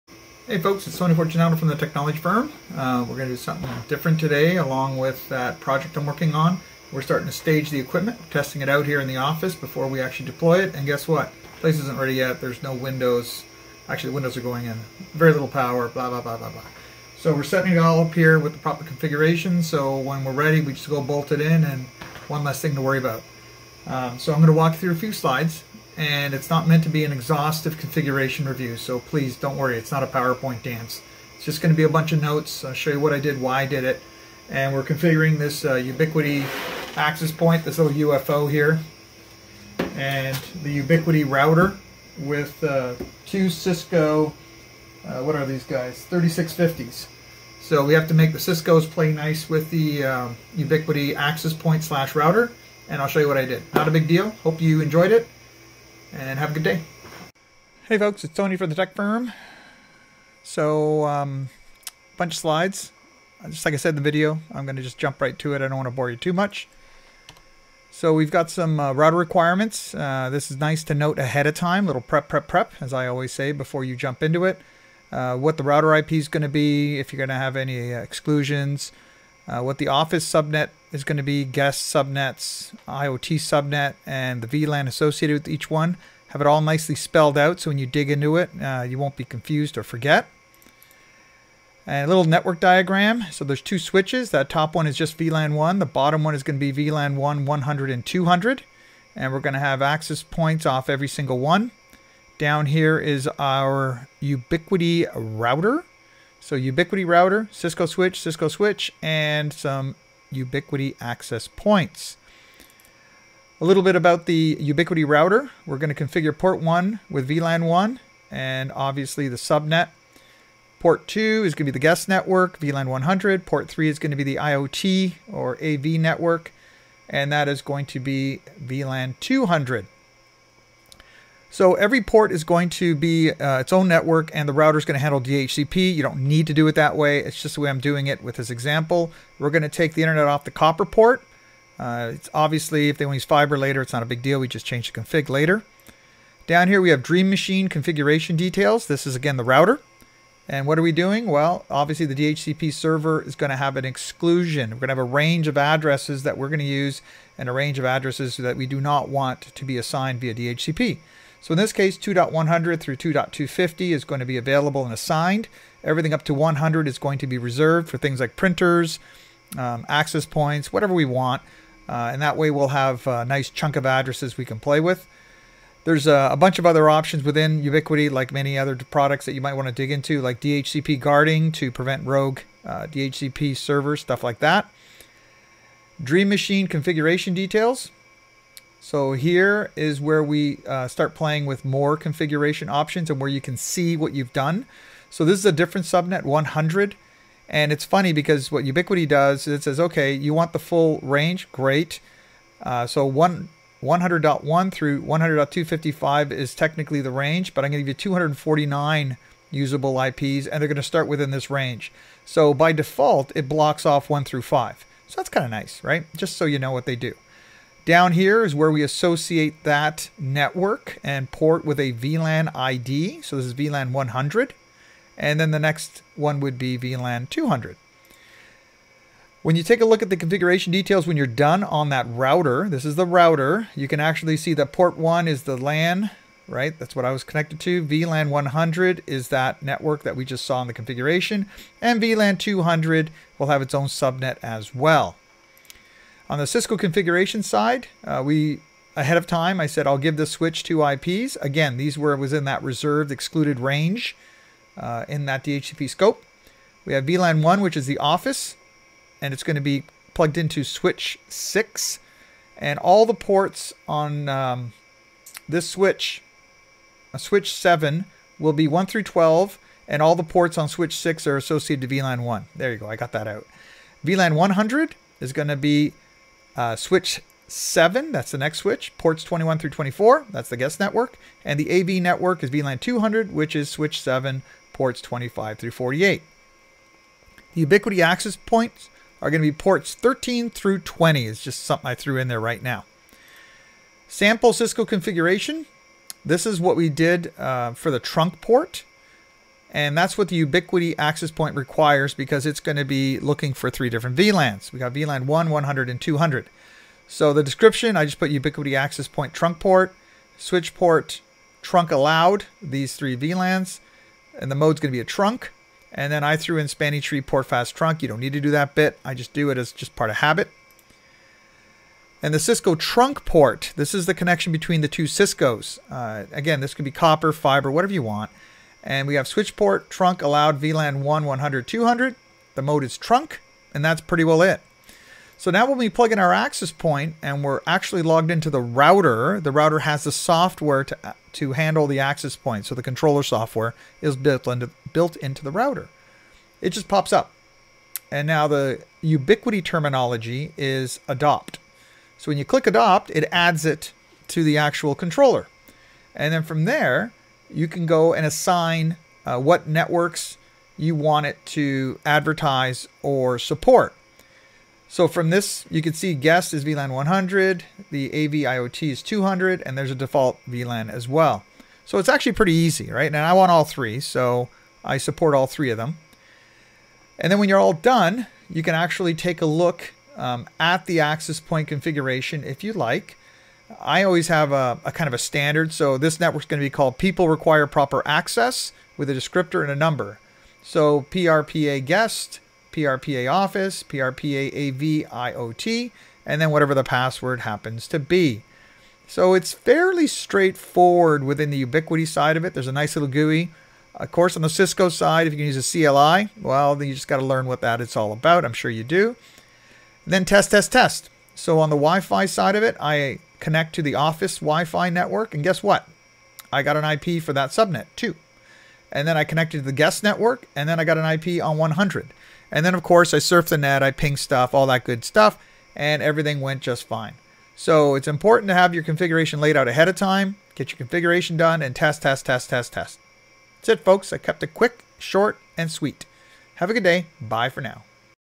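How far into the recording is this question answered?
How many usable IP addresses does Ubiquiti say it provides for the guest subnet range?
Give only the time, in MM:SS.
03:28.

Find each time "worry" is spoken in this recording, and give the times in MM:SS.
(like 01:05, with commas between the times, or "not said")
00:22, 00:29.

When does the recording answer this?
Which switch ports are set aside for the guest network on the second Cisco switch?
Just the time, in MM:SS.
04:39.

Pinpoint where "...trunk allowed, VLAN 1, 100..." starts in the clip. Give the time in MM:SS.
05:29.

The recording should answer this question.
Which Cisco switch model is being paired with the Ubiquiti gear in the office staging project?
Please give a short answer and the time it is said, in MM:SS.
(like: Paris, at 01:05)
3650, at 00:46.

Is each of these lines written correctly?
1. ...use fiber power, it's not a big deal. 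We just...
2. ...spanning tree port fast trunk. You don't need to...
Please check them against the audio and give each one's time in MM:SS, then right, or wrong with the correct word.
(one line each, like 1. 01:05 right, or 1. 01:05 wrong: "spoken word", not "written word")
1. 02:23 wrong: "later", not "power"
2. 05:16 right.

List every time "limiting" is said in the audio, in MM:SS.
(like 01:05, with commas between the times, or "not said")
not said.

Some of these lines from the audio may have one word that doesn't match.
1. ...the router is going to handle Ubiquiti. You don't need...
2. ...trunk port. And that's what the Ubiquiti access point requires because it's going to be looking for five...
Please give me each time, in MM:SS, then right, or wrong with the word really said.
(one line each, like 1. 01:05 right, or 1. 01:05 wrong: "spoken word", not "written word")
1. 02:14 wrong: "DHCP", not "Ubiquiti"
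2. 04:57 wrong: "three", not "five".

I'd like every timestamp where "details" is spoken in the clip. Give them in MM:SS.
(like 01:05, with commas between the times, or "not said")
02:28, 03:07, 03:50.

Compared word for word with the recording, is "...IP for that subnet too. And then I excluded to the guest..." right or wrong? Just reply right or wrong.
wrong.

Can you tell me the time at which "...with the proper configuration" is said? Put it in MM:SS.
00:18.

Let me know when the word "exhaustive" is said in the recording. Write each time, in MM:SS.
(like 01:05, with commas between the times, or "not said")
00:27.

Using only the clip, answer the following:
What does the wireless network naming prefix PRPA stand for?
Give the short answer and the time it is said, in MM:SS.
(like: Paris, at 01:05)
people require proper access, at 06:26.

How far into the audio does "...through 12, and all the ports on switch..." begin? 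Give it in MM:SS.
04:28.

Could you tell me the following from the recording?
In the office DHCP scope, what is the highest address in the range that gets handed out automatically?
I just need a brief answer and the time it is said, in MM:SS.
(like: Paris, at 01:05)
2.250, at 02:42.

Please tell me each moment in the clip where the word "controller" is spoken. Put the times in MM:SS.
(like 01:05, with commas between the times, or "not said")
05:42, 05:54.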